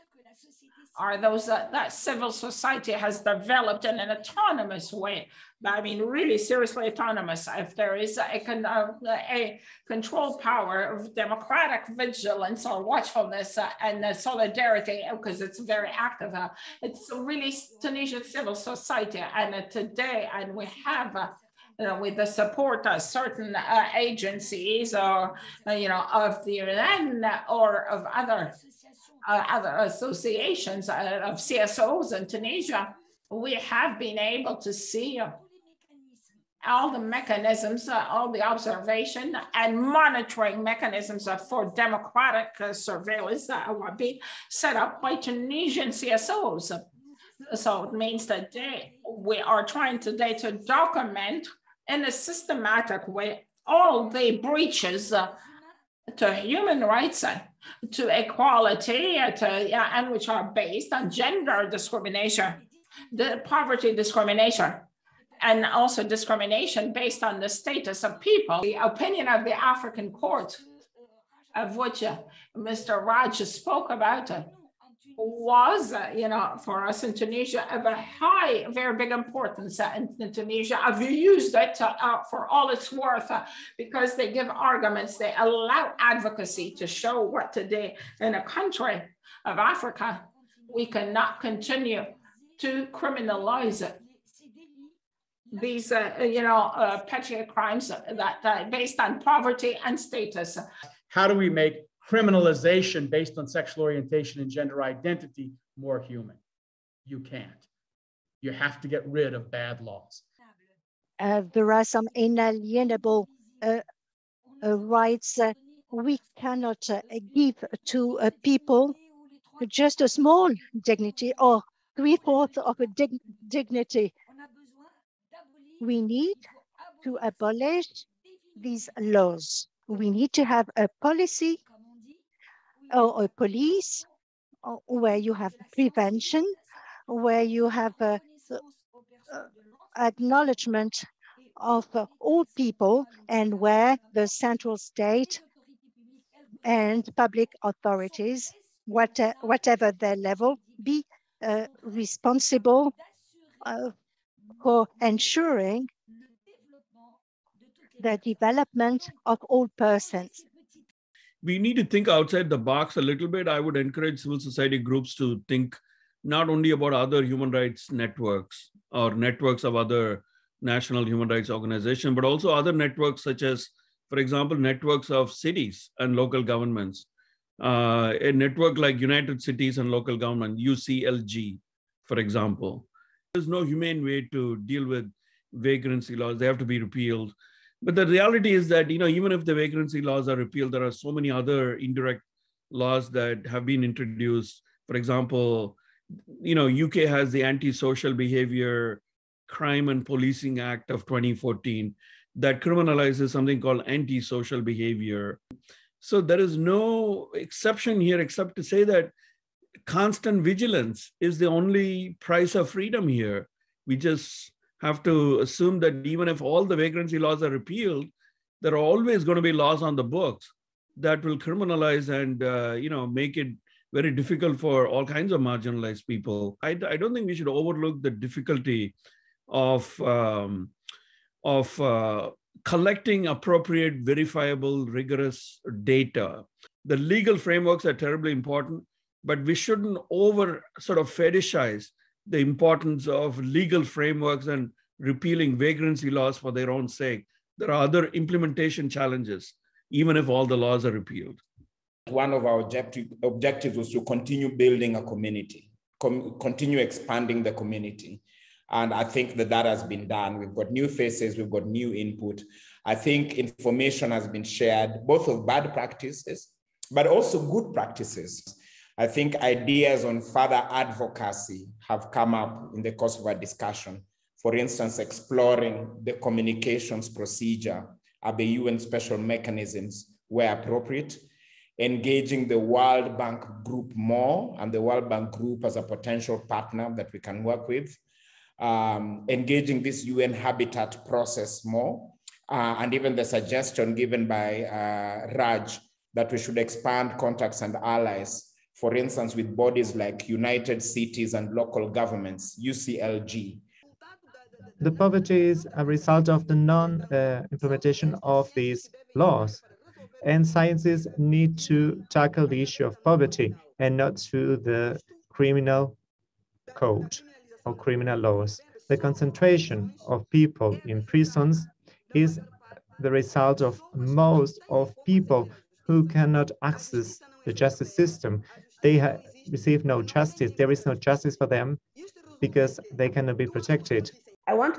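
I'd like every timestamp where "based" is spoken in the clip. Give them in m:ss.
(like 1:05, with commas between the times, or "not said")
1:00, 1:06, 1:38, 1:43.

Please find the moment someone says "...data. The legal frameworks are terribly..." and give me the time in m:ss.
3:55.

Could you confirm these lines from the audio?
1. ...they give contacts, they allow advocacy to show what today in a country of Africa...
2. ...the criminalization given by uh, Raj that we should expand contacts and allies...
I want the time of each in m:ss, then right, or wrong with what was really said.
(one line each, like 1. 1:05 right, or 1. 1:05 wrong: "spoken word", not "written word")
1. 1:24 wrong: "arguments", not "contacts"
2. 4:53 wrong: "suggestion", not "criminalization".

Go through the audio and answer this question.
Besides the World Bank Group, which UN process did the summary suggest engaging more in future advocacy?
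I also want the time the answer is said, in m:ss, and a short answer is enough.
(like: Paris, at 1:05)
UN habitat, at 4:50.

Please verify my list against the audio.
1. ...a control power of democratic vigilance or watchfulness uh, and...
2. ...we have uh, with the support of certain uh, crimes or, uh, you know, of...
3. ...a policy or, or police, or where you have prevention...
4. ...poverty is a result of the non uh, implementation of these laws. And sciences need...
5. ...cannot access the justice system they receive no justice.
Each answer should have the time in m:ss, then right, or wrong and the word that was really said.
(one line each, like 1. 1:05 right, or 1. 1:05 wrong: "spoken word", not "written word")
1. 0:08 right
2. 0:20 wrong: "agencies", not "crimes"
3. 2:10 right
4. 5:04 right
5. 5:26 right.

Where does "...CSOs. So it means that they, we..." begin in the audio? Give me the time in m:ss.
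0:45.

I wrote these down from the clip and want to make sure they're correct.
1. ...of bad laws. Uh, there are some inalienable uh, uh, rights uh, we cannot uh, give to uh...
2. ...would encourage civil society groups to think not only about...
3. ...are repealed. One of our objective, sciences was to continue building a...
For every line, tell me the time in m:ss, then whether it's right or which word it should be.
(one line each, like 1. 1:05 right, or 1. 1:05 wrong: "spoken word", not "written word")
1. 1:49 right
2. 2:43 right
3. 4:10 wrong: "objectives", not "sciences".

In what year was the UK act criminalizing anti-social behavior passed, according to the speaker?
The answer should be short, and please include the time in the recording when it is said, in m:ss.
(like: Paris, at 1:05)
2014, at 3:21.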